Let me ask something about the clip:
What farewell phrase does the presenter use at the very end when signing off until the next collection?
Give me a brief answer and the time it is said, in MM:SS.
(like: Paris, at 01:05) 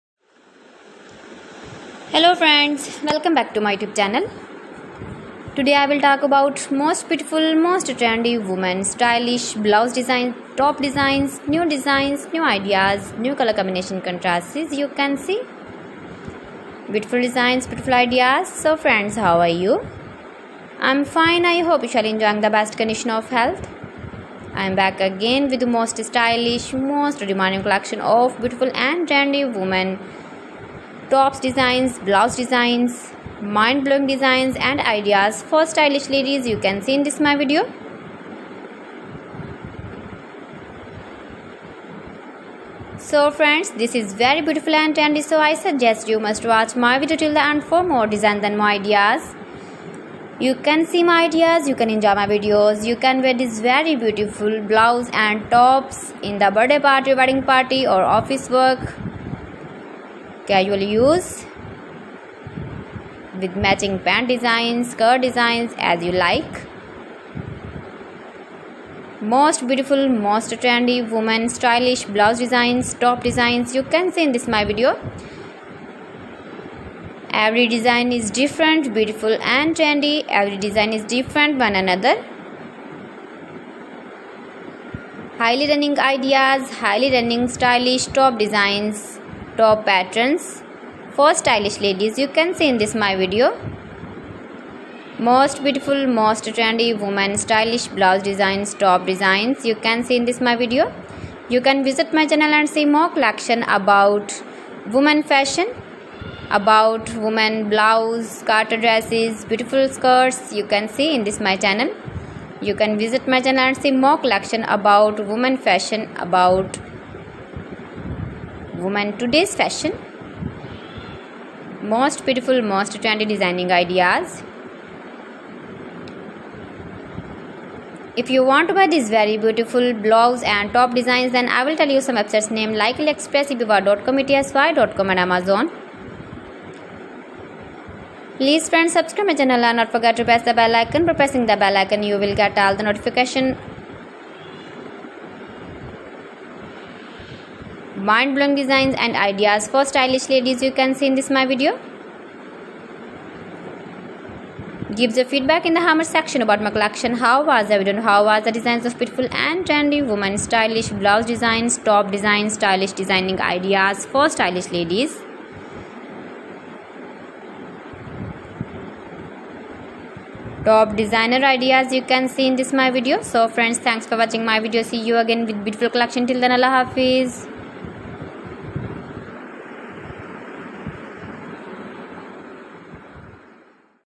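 Allah Hafiz, at 02:56.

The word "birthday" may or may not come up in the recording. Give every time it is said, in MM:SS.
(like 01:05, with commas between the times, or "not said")
00:56.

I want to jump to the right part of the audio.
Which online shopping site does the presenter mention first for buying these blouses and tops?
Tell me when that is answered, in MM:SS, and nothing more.
02:13.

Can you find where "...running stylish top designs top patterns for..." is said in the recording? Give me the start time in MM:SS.
01:27.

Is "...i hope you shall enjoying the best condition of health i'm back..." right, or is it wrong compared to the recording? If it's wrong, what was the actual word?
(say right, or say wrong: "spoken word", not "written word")
right.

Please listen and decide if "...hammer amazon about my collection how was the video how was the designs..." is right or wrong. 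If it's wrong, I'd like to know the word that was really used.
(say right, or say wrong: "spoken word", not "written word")
wrong: "section", not "amazon".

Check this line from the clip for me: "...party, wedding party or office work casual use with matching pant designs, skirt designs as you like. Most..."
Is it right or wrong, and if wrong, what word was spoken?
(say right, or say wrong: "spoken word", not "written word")
right.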